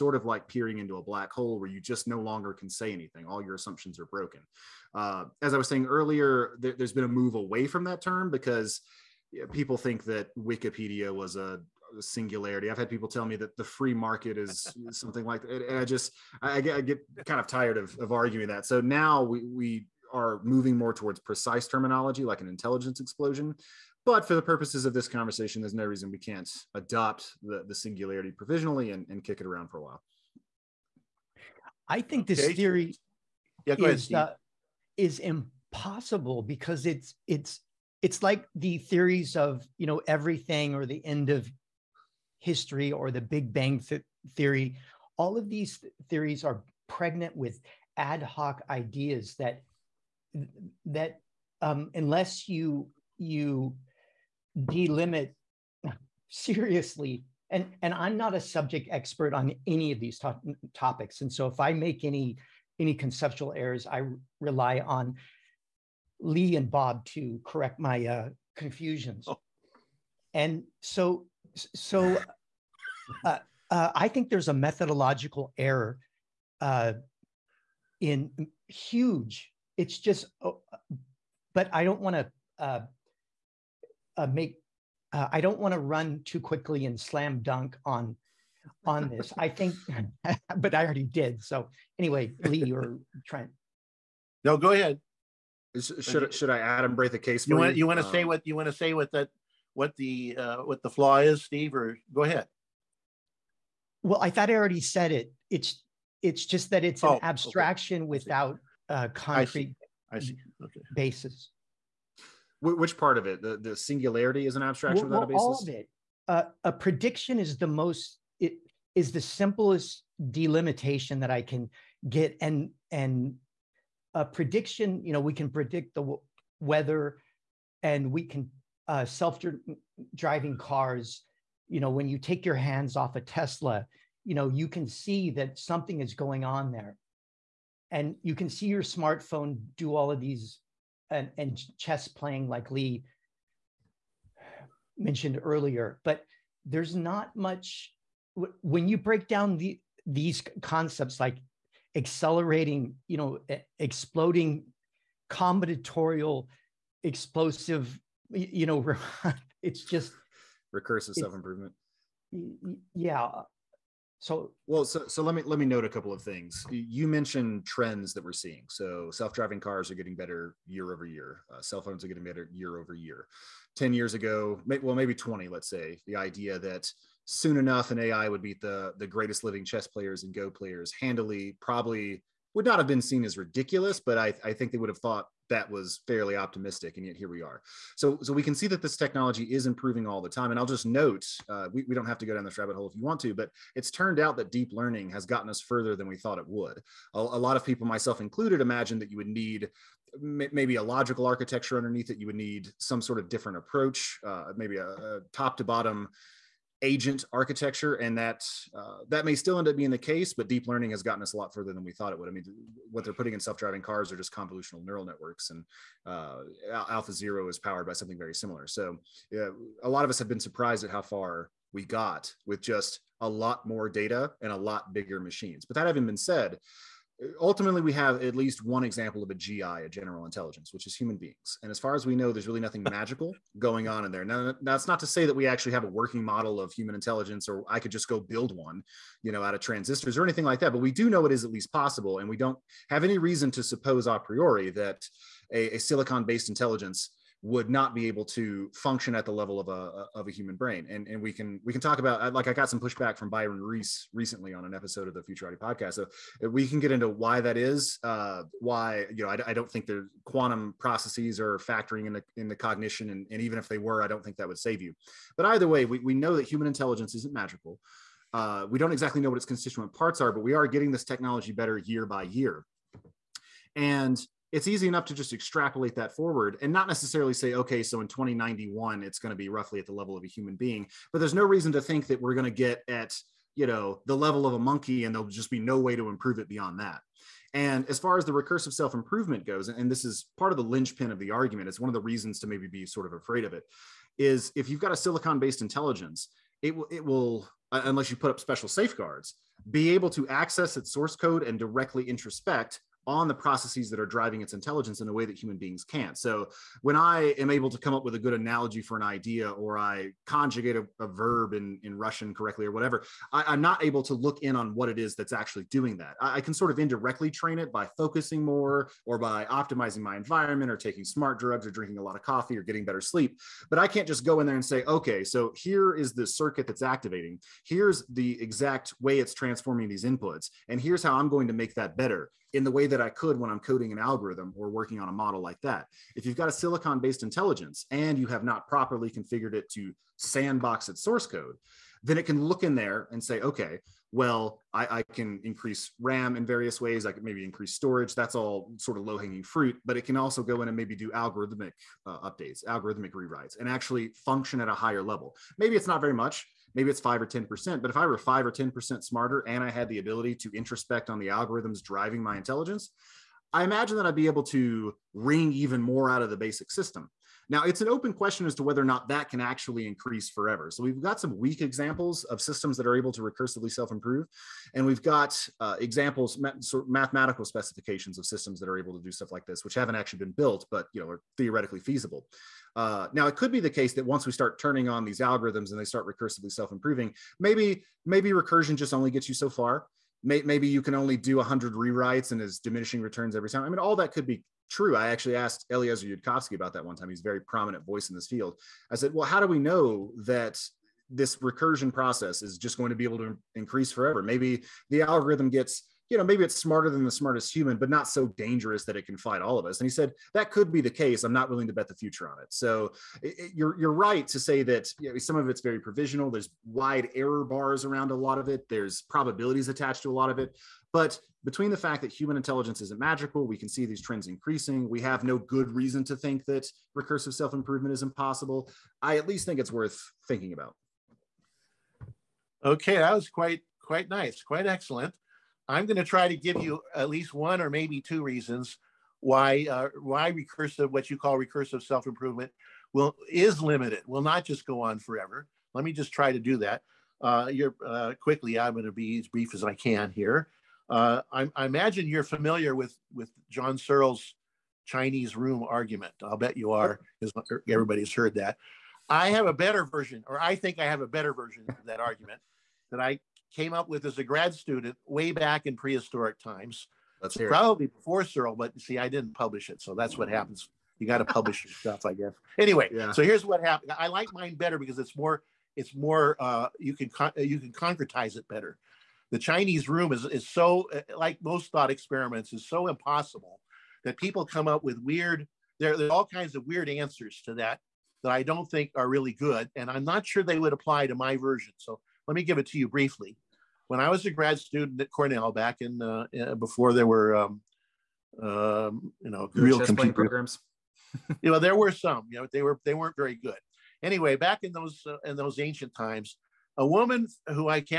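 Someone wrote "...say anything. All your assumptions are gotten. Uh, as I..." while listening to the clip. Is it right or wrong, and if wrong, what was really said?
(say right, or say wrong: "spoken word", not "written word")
wrong: "broken", not "gotten".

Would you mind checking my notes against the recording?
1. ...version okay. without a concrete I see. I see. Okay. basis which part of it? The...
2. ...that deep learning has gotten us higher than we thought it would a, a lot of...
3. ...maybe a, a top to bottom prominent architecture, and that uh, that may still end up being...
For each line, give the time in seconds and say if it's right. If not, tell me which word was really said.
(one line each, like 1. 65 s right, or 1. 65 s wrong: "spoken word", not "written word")
1. 107 s wrong: "abstraction", not "version"
2. 194 s wrong: "further", not "higher"
3. 204 s wrong: "agent", not "prominent".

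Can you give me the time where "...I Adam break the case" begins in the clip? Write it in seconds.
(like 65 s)
96 s.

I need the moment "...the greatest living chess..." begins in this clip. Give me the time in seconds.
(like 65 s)
178 s.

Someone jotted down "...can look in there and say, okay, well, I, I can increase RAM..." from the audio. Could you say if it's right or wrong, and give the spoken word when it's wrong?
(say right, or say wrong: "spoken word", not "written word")
right.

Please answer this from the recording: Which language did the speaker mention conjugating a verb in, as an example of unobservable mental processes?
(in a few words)
Russian.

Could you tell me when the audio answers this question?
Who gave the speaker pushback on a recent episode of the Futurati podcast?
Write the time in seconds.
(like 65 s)
253 s.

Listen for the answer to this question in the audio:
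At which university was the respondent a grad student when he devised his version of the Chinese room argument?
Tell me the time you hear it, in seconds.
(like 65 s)
495 s.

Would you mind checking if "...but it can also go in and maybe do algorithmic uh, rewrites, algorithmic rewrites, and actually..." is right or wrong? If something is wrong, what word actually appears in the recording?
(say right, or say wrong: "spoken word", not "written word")
wrong: "updates", not "rewrites".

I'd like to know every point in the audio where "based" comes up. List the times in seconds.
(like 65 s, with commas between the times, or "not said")
246 s, 295 s, 336 s.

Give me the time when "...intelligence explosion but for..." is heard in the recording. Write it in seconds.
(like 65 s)
22 s.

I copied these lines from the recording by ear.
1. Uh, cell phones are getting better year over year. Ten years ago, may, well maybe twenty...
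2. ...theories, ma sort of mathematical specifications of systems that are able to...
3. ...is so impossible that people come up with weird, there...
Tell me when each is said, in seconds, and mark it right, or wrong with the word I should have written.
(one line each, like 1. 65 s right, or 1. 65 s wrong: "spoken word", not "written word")
1. 171 s right
2. 375 s wrong: "examples", not "theories"
3. 482 s right.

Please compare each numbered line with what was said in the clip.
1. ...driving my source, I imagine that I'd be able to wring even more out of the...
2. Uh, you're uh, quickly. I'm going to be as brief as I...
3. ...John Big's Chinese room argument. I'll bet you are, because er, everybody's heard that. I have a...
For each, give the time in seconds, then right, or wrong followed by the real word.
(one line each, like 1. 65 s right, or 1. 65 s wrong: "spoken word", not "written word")
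1. 361 s wrong: "intelligence", not "source"
2. 447 s right
3. 453 s wrong: "Searle", not "Big".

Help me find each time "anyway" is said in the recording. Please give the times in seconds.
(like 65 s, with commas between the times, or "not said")
91 s, 472 s, 504 s.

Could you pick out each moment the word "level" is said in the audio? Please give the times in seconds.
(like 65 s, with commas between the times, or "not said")
249 s, 279 s, 284 s, 355 s.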